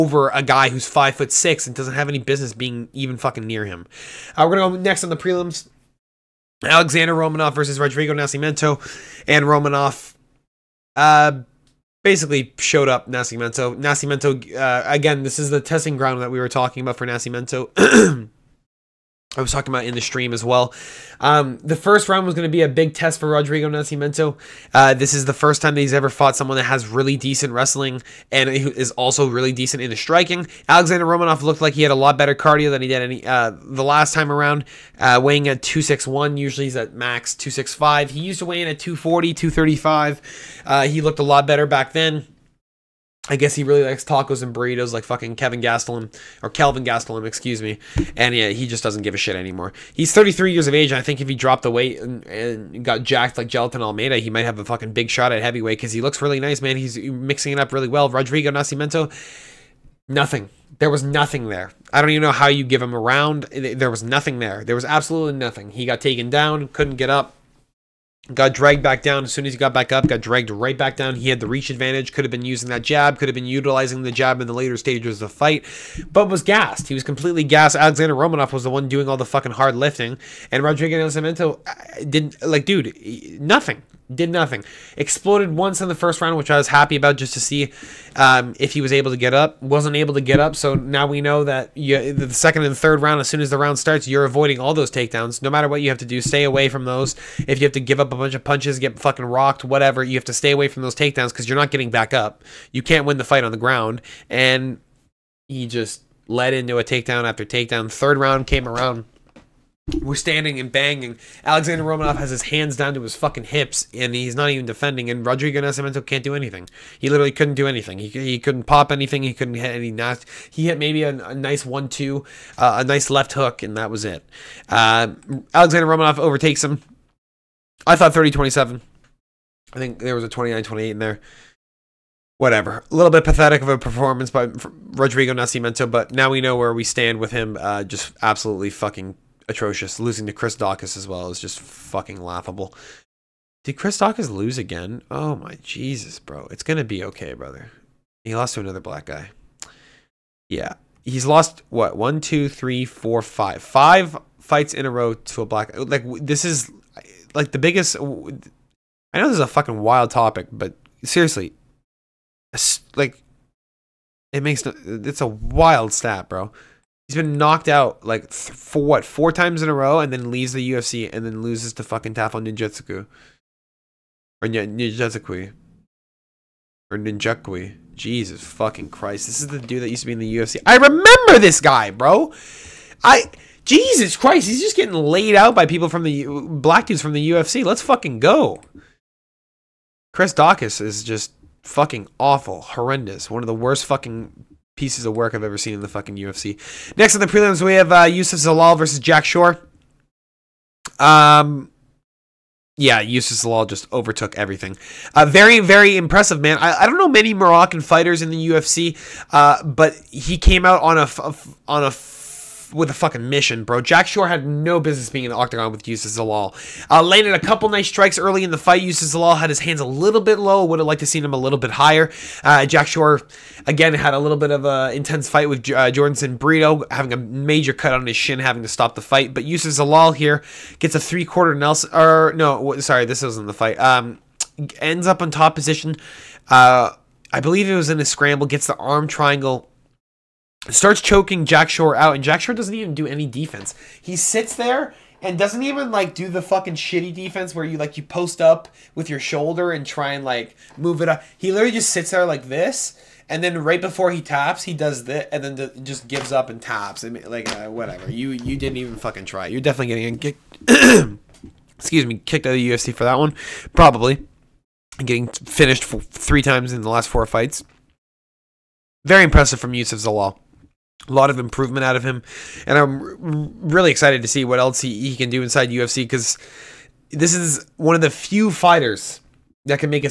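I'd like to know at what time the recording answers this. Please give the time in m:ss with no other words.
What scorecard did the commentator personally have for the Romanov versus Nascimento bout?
2:08.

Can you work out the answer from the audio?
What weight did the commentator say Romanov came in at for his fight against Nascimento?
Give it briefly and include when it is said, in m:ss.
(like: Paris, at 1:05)
261, at 0:35.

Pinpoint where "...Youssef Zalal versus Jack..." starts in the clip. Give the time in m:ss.
3:18.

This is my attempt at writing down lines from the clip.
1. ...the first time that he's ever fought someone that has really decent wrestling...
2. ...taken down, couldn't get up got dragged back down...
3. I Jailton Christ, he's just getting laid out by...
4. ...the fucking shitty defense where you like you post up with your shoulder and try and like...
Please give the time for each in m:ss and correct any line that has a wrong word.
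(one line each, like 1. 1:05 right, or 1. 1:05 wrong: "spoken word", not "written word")
1. 0:25 right
2. 1:06 right
3. 3:03 wrong: "Jesus", not "Jailton"
4. 4:06 right.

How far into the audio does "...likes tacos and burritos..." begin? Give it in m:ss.
0:43.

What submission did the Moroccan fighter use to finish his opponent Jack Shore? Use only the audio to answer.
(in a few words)
arm triangle.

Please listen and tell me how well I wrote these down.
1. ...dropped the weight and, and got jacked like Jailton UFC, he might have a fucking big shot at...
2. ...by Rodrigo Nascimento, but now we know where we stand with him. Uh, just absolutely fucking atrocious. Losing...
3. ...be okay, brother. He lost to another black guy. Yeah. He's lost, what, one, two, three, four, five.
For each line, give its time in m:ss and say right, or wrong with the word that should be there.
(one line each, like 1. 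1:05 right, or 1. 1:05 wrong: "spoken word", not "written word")
1. 0:51 wrong: "Almeida", not "UFC"
2. 2:14 right
3. 2:26 right.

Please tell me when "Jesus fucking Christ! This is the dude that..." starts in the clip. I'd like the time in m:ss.
2:57.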